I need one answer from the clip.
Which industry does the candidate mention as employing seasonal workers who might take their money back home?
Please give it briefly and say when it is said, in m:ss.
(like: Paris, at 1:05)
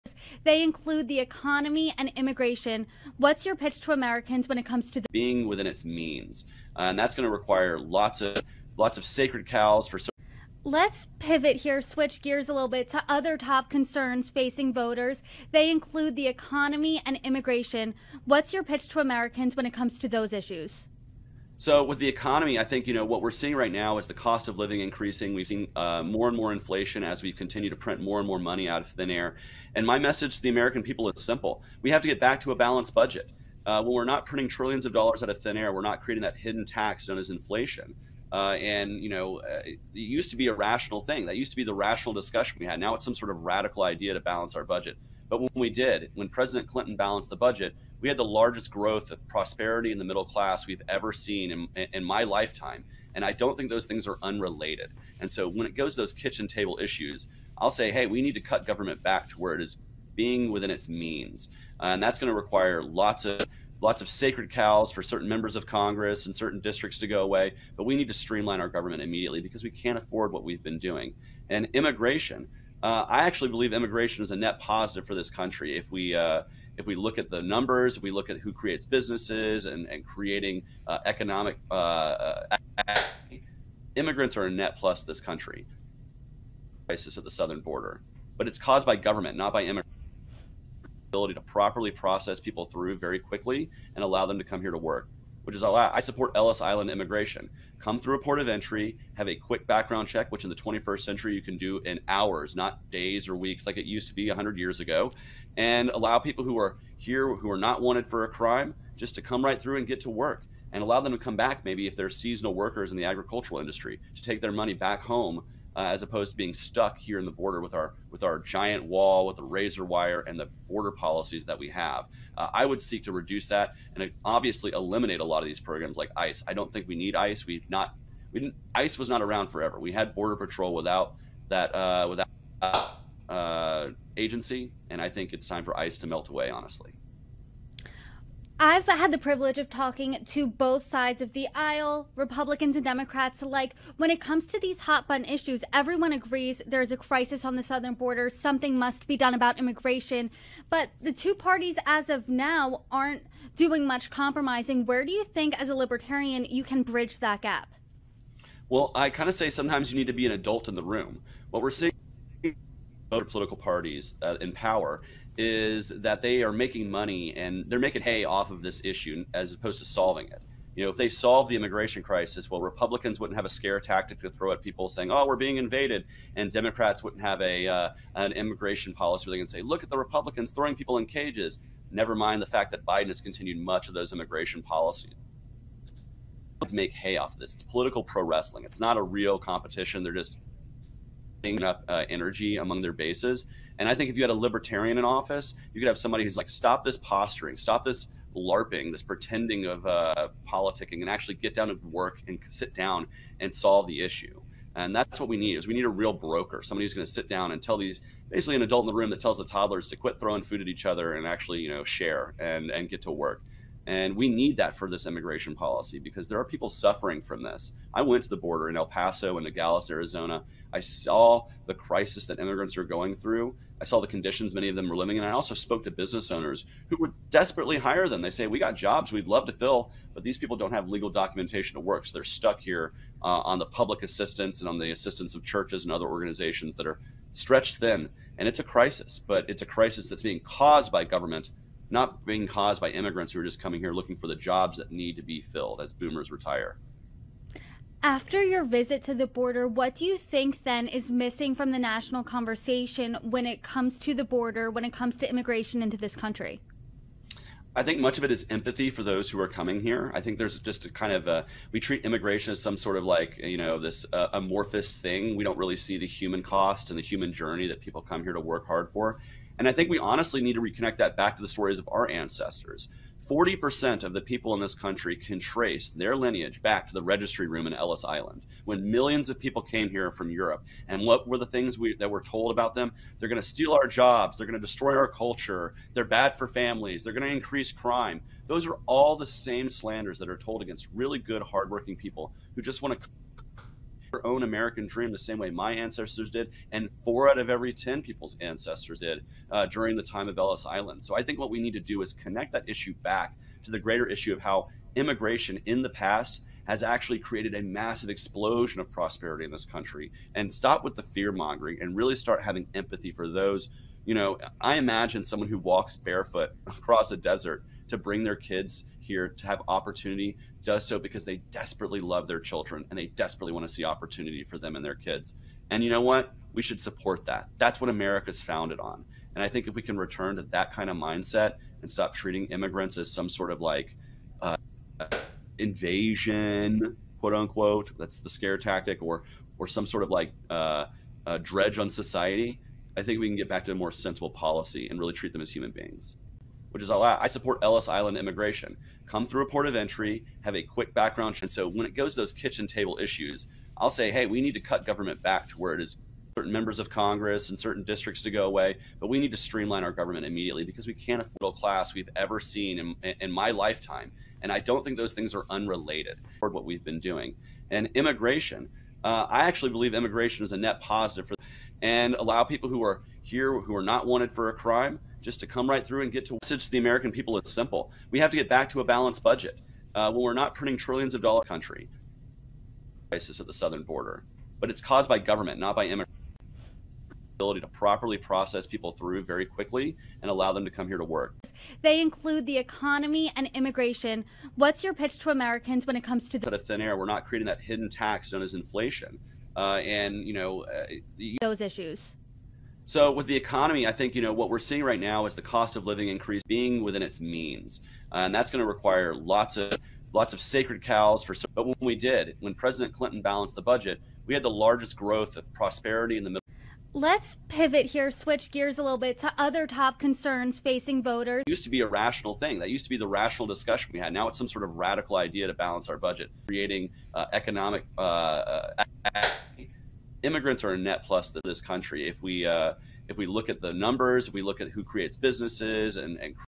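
agricultural industry, at 1:53.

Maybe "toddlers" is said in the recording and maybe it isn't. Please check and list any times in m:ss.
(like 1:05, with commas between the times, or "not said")
3:29.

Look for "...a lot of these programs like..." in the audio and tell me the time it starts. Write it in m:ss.
2:05.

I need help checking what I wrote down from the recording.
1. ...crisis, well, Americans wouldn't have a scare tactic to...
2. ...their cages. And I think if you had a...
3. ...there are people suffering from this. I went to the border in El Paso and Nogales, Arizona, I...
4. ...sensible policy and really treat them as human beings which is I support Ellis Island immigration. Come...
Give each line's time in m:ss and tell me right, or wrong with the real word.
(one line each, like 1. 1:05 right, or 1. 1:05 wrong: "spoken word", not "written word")
1. 2:52 wrong: "Republicans", not "Americans"
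2. 3:12 wrong: "bases", not "cages"
3. 3:36 right
4. 5:43 right.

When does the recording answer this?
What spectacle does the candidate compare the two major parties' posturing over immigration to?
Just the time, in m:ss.
3:07.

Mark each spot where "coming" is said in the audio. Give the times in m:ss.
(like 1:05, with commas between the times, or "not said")
4:03, 4:19.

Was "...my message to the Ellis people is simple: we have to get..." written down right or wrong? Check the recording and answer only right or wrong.
wrong.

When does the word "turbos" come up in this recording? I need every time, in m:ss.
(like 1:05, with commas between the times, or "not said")
not said.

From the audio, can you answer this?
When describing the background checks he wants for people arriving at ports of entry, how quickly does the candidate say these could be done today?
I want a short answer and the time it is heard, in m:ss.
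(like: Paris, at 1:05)
in hours, at 1:42.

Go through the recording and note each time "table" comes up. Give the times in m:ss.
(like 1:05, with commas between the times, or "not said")
0:56, 5:52.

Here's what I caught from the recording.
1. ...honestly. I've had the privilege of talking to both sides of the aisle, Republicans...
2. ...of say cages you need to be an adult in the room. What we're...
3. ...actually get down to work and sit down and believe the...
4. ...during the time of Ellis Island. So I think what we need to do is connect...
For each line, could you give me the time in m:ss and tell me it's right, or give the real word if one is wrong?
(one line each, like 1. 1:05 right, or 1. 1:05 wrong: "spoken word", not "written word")
1. 2:16 right
2. 2:39 wrong: "sometimes", not "cages"
3. 3:21 wrong: "solve", not "believe"
4. 4:59 right.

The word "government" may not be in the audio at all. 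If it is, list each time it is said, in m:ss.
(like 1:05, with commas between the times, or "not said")
0:58, 1:08, 1:28, 4:01, 5:54, 5:59, 6:25.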